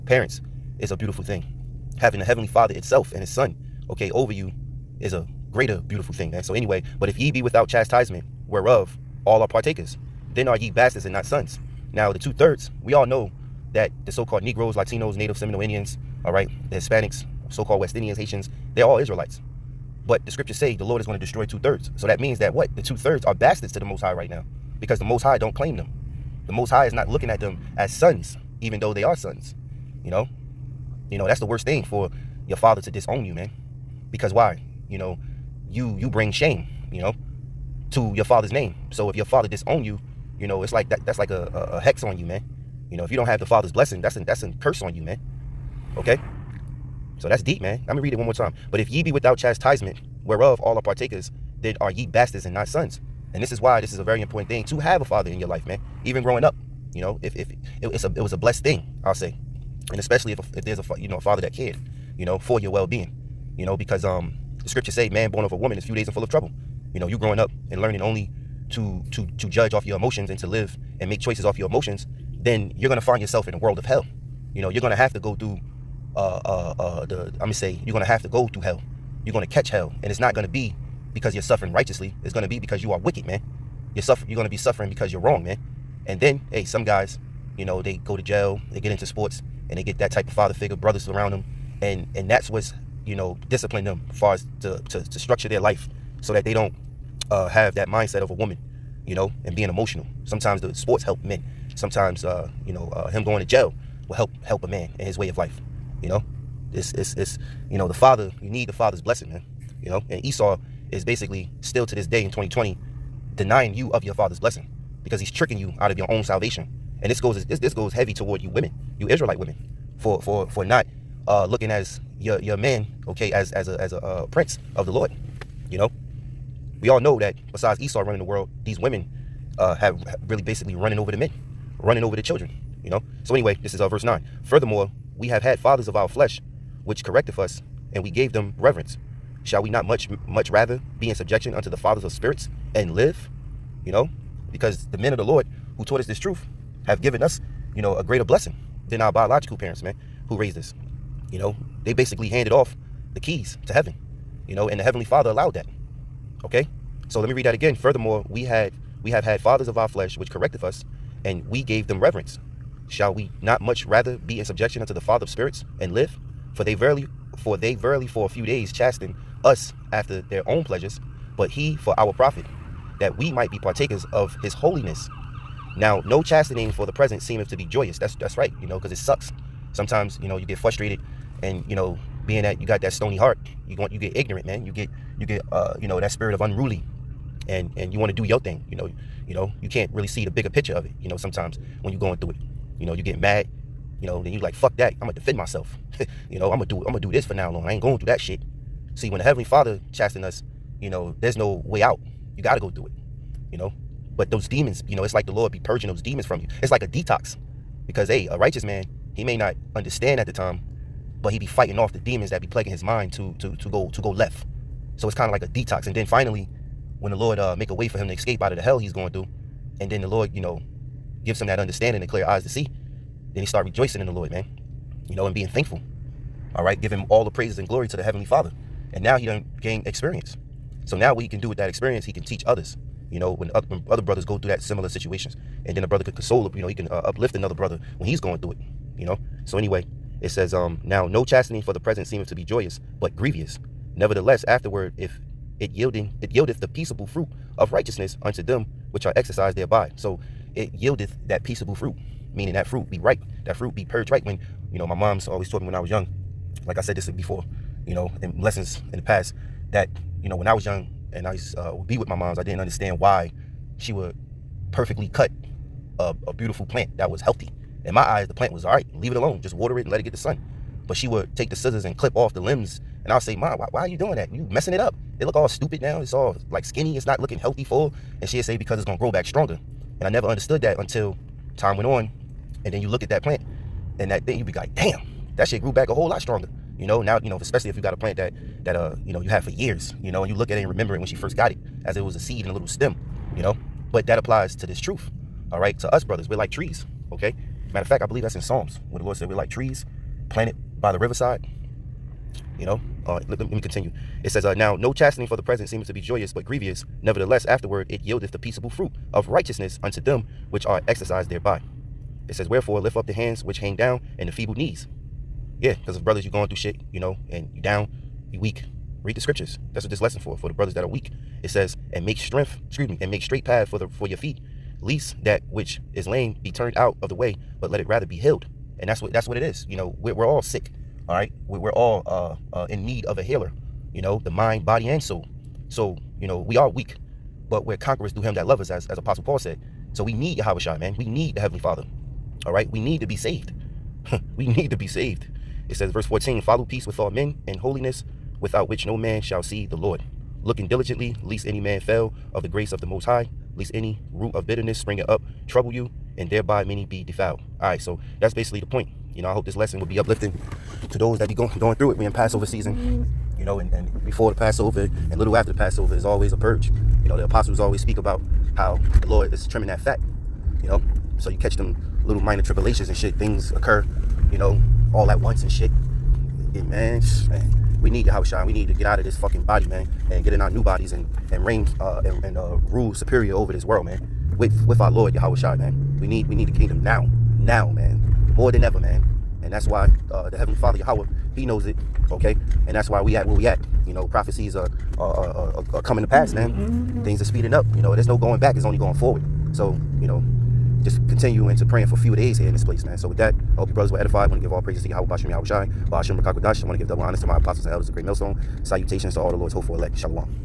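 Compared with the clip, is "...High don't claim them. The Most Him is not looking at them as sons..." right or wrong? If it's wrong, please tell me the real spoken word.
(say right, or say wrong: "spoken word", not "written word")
wrong: "High", not "Him".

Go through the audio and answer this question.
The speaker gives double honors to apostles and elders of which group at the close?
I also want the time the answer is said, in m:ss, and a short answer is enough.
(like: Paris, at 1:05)
Great Millstone, at 6:47.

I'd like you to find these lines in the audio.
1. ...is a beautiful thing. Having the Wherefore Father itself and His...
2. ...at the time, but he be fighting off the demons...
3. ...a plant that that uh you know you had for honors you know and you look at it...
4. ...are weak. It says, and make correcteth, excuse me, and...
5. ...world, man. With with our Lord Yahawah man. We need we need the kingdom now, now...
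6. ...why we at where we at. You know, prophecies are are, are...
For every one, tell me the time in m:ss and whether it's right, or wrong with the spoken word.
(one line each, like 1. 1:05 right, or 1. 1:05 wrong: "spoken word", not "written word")
1. 0:00 wrong: "Heavenly", not "Wherefore"
2. 3:30 right
3. 4:47 wrong: "years", not "honors"
4. 5:20 wrong: "strength", not "correcteth"
5. 6:23 right
6. 6:32 right.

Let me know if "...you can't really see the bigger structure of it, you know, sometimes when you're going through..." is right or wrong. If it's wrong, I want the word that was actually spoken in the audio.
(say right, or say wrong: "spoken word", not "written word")
wrong: "picture", not "structure".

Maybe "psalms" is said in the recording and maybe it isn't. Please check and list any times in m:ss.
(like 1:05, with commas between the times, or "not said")
4:58.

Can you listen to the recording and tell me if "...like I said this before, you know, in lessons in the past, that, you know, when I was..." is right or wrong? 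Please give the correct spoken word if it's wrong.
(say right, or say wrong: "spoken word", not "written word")
right.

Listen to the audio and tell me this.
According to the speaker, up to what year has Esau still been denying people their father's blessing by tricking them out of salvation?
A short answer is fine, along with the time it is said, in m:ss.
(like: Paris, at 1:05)
2020, at 1:52.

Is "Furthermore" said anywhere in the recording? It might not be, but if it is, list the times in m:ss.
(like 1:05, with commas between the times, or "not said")
2:14, 2:37.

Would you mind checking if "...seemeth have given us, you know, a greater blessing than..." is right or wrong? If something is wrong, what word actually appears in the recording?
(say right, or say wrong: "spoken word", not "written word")
wrong: "truth", not "seemeth".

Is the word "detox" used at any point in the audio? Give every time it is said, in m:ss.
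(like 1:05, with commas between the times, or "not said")
3:26, 3:35.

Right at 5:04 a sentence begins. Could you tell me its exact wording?
It says, uh, Now, no chastening for the present seemeth to be joyous, but grievous.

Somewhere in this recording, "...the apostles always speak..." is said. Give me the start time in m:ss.
6:07.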